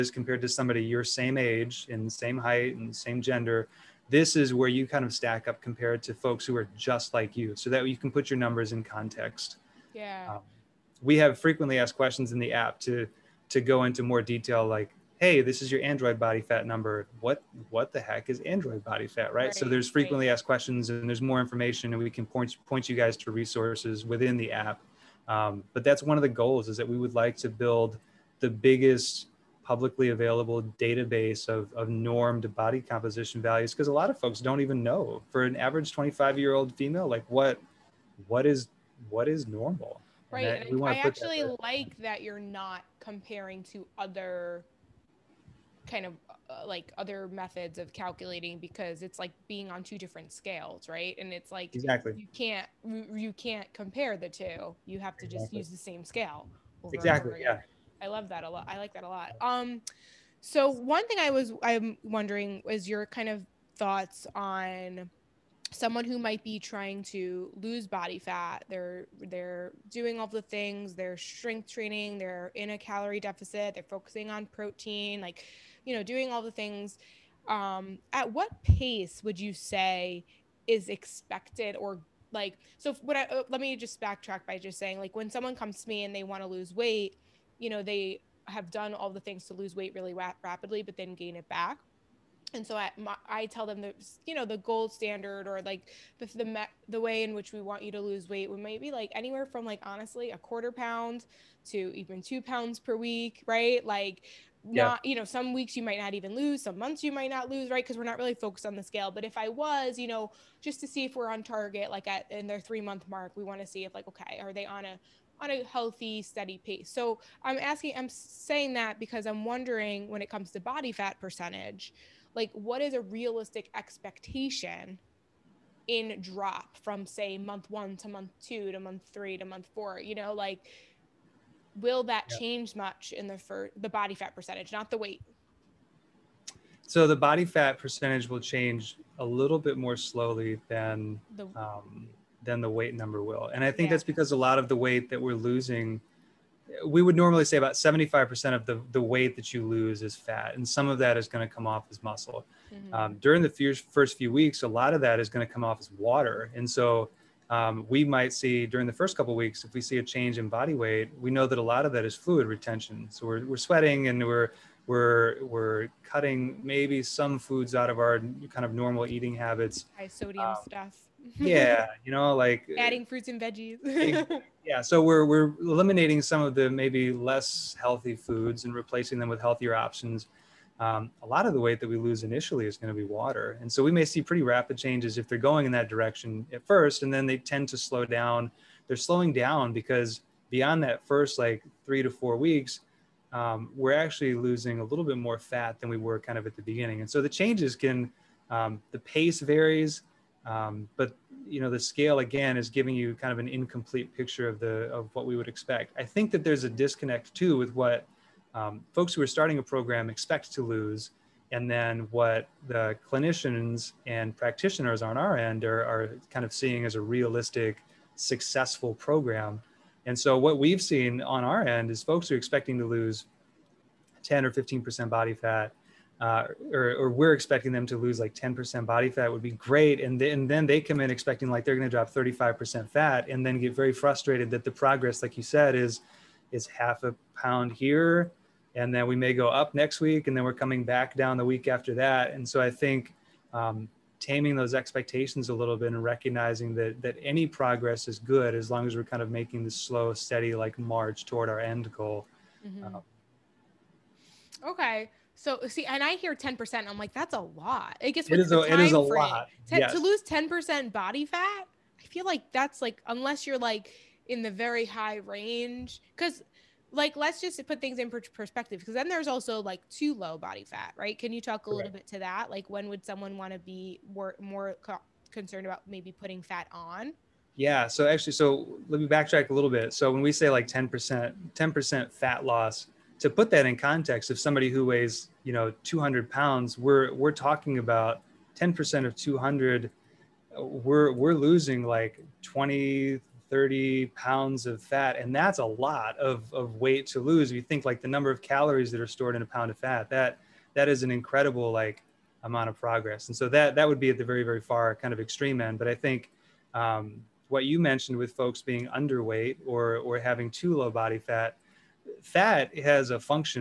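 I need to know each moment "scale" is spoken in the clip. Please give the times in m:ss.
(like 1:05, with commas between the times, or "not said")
0:50, 0:56, 1:48, 3:21.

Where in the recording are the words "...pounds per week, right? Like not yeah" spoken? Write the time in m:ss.
1:42.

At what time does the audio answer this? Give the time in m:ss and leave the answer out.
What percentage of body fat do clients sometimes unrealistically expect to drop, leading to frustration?
3:52.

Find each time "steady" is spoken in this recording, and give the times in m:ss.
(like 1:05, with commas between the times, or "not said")
1:56, 4:10.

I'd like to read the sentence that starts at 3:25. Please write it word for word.
I think that there's a disconnect too with what um, folks who are starting a program expect to lose.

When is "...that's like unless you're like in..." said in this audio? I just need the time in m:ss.
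4:22.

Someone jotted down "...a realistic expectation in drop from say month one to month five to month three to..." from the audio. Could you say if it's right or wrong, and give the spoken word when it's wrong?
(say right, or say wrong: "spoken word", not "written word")
wrong: "two", not "five".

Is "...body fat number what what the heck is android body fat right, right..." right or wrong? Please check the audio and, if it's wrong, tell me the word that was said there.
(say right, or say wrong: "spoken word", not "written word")
right.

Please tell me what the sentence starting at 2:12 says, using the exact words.
change much in the for the body fat percentage, not the weight?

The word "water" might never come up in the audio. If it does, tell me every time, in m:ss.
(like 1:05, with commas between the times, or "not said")
2:35, 3:03.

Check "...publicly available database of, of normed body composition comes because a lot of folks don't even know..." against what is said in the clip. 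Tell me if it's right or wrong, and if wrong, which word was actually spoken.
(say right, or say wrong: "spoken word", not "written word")
wrong: "values", not "comes".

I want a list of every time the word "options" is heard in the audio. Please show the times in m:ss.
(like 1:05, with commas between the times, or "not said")
2:59.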